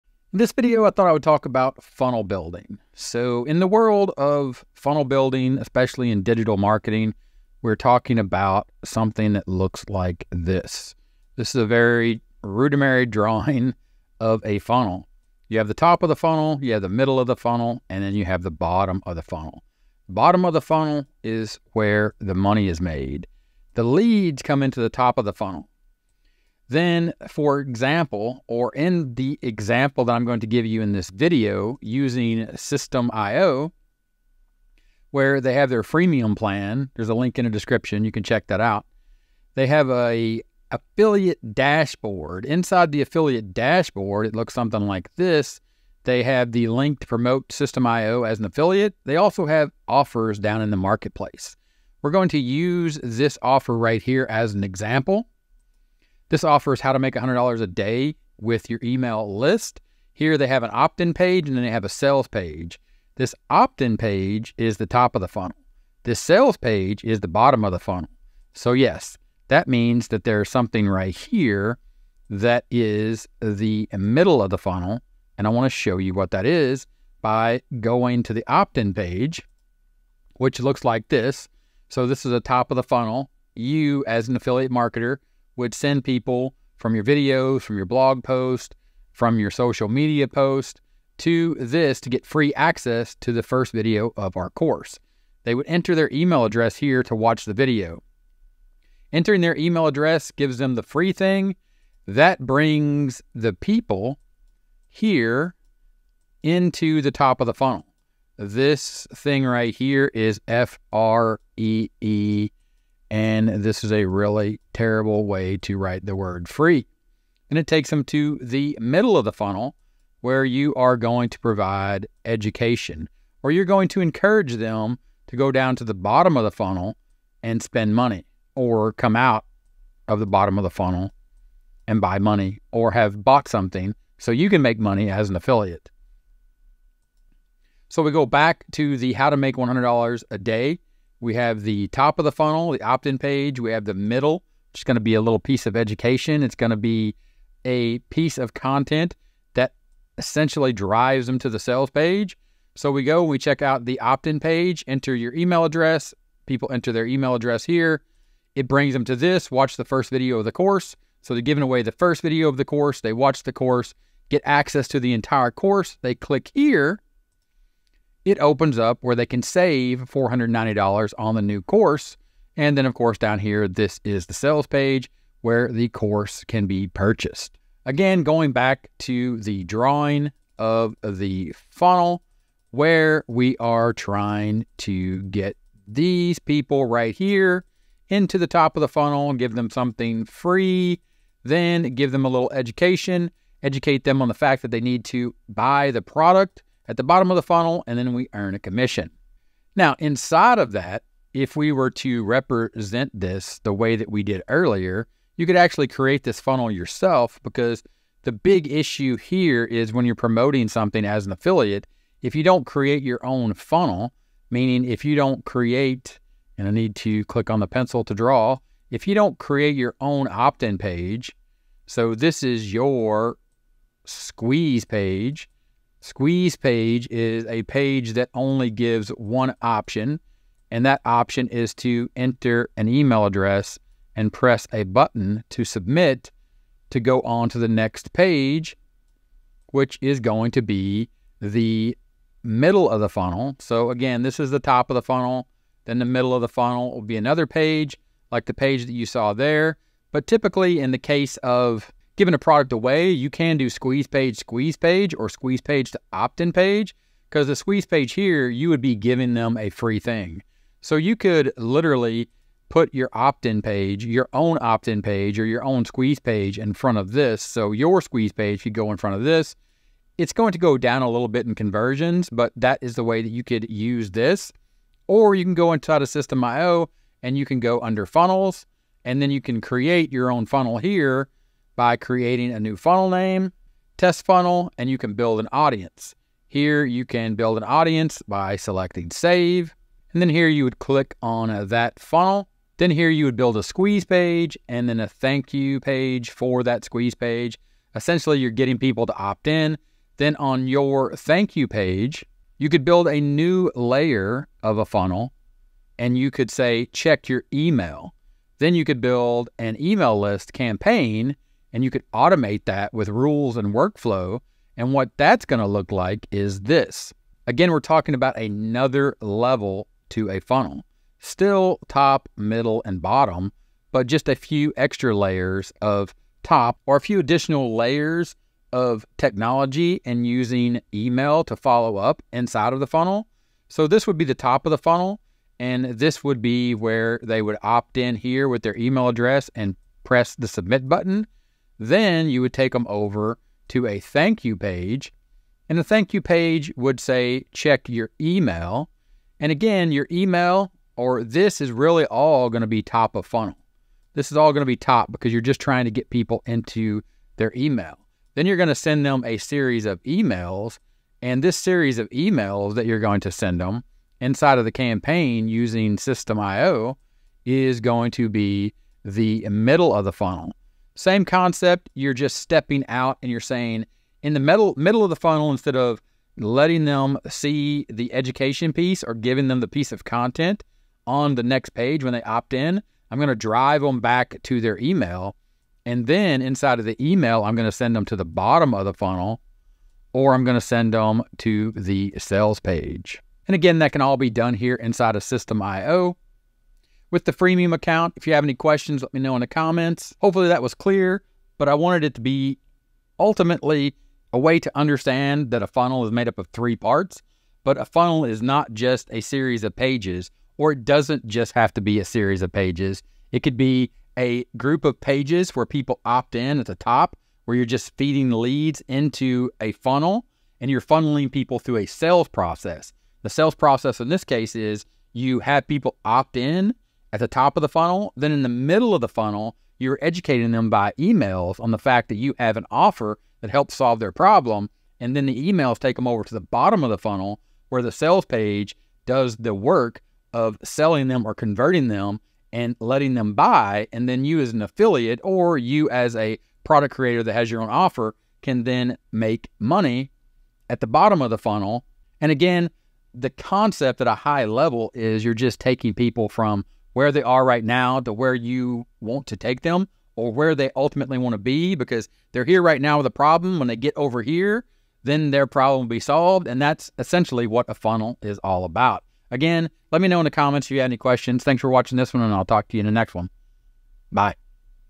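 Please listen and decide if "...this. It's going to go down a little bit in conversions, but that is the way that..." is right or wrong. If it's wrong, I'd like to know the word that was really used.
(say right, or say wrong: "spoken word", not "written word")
right.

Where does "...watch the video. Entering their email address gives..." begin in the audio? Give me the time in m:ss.
1:37.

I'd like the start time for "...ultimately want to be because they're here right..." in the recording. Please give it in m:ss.
7:40.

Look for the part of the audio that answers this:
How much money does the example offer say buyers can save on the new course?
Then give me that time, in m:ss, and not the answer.
2:50.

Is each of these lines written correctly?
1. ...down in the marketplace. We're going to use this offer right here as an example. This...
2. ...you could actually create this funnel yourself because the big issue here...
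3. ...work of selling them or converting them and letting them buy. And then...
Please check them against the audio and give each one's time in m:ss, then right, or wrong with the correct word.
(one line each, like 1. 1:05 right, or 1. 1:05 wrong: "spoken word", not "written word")
1. 0:50 right
2. 3:25 right
3. 7:19 right.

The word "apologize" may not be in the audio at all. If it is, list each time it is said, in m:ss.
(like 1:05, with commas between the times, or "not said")
not said.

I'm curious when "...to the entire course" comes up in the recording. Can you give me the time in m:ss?
2:44.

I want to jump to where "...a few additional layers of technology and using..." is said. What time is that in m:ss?
5:26.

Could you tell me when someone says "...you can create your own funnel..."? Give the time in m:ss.
4:39.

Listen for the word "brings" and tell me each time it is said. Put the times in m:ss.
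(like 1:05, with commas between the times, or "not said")
1:42, 2:38.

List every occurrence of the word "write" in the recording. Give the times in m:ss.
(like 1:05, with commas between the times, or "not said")
1:55.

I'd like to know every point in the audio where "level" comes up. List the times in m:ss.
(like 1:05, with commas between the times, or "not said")
5:19, 7:34.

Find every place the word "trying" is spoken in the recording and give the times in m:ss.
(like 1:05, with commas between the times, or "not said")
3:03, 5:55.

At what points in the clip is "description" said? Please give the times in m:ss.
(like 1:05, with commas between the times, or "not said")
0:37.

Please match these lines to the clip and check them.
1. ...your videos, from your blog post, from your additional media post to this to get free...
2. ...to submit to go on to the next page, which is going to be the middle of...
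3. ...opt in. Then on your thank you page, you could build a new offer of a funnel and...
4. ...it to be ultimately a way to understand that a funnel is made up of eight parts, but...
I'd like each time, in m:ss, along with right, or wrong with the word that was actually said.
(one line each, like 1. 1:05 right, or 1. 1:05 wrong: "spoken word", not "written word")
1. 1:26 wrong: "social", not "additional"
2. 3:55 right
3. 4:59 wrong: "layer", not "offer"
4. 6:42 wrong: "three", not "eight".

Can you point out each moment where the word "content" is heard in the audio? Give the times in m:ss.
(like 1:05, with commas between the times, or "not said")
2:28, 6:20.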